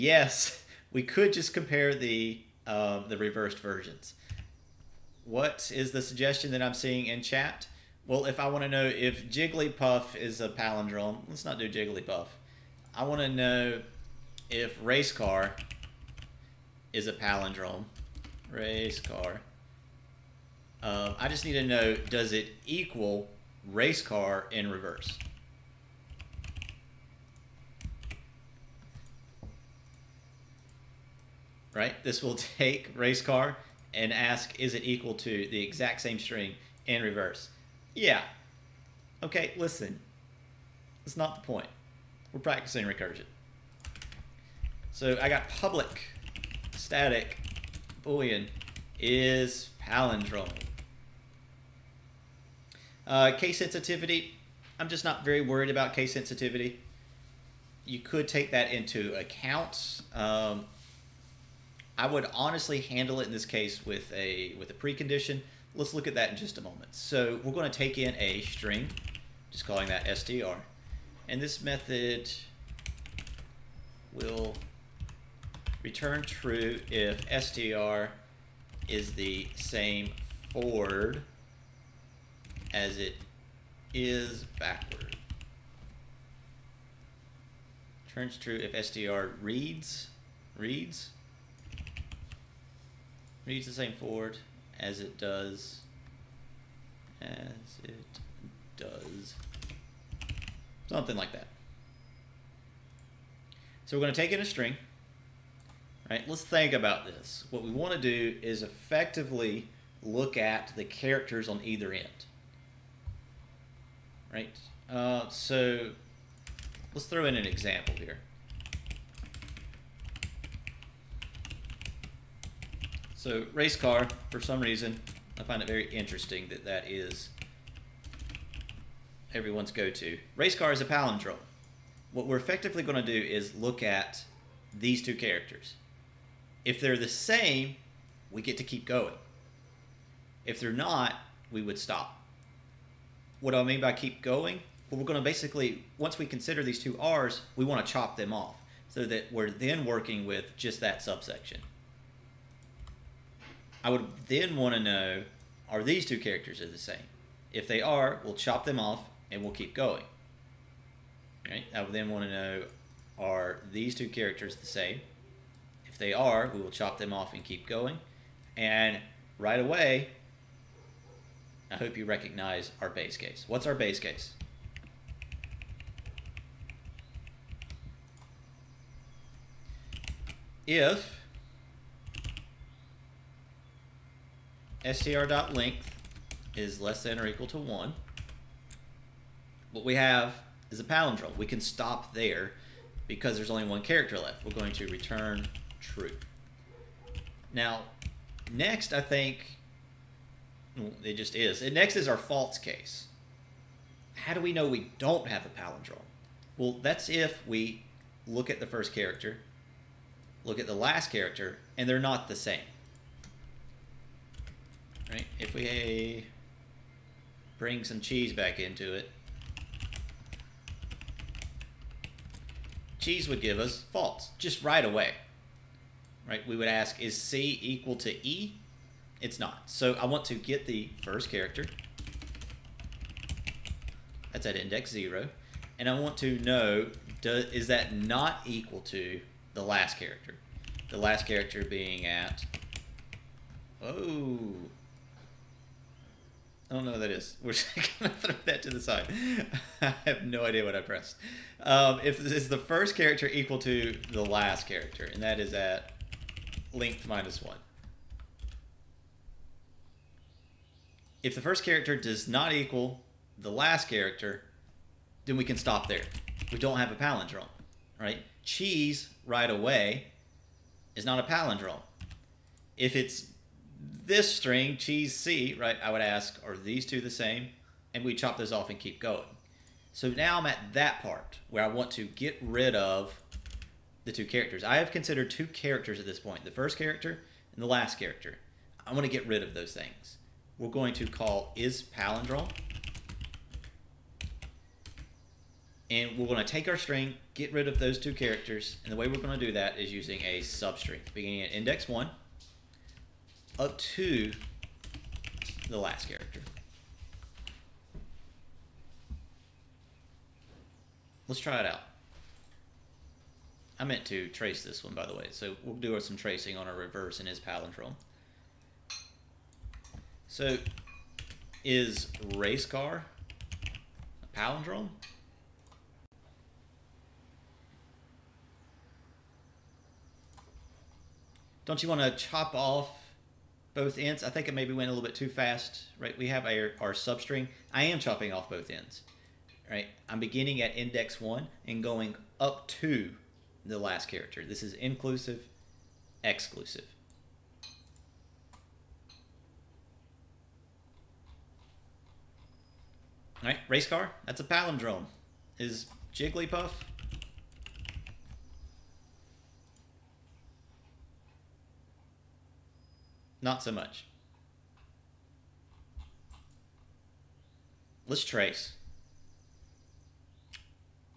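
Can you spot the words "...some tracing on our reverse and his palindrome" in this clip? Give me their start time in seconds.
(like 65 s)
315 s.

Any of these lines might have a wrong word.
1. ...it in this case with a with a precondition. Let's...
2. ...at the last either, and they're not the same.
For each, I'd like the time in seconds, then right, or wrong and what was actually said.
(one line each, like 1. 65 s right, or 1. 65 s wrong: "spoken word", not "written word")
1. 63 s right
2. 210 s wrong: "character", not "either".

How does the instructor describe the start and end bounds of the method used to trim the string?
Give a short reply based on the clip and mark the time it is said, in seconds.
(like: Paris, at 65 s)
inclusive, exclusive, at 344 s.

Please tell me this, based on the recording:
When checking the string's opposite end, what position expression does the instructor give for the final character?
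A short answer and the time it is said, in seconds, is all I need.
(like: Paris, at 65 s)
length minus one, at 256 s.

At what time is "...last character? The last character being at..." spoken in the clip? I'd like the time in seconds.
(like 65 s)
239 s.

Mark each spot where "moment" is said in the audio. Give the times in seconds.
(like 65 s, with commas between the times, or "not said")
66 s.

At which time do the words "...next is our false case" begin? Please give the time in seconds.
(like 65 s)
201 s.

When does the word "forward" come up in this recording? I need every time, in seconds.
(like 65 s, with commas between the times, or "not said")
80 s, 93 s.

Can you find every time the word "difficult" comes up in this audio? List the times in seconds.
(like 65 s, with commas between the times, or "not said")
not said.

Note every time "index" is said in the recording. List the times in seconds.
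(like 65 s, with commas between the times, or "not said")
234 s, 301 s, 340 s.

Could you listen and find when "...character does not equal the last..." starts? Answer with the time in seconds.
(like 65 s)
261 s.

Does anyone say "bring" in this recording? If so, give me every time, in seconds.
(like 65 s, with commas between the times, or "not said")
217 s.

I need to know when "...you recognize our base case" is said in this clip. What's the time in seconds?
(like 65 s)
171 s.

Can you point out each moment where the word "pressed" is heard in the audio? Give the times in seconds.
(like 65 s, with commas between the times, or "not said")
250 s.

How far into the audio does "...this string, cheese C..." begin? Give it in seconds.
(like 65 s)
274 s.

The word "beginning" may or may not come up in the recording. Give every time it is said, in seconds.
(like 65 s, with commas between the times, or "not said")
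301 s, 340 s.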